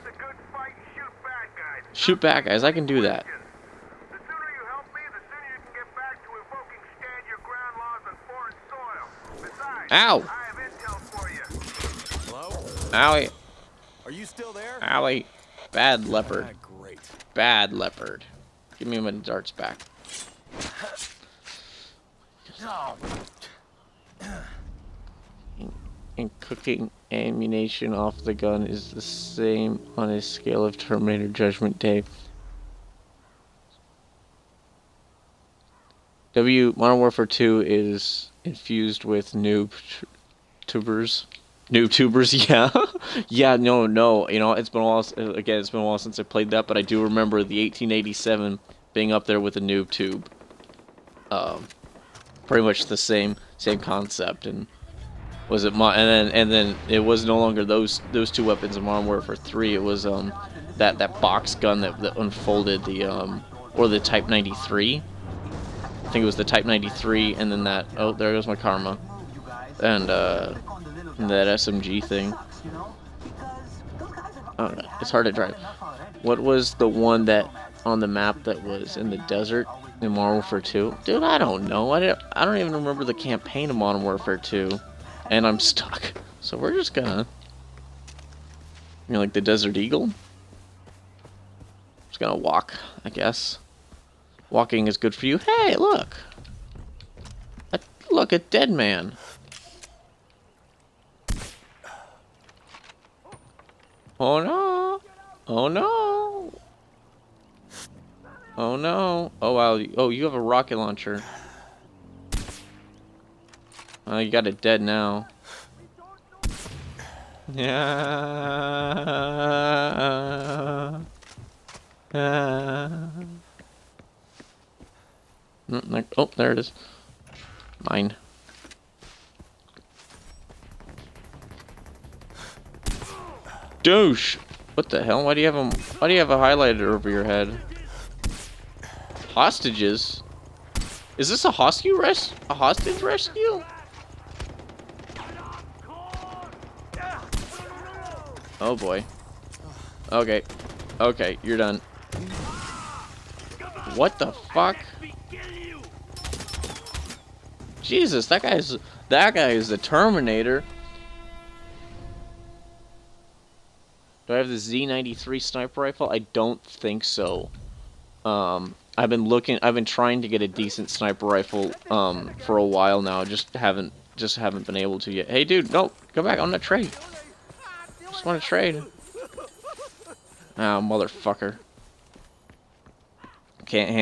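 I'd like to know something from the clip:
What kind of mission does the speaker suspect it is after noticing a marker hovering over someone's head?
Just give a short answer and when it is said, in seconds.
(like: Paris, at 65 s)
Hostage rescue, at 142 s.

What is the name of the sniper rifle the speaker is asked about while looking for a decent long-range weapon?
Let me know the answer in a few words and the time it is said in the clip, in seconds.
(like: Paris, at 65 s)
Z93, at 164 s.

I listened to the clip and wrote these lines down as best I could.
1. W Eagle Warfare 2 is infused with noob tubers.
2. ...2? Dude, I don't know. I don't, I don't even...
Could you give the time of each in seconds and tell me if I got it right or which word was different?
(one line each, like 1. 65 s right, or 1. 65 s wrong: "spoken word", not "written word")
1. 36 s wrong: "Modern", not "Eagle"
2. 80 s right.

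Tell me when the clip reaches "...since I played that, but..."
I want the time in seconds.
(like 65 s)
45 s.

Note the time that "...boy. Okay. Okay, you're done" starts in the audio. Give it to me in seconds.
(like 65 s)
148 s.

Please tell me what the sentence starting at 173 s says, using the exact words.
Just haven't just haven't been able to yet.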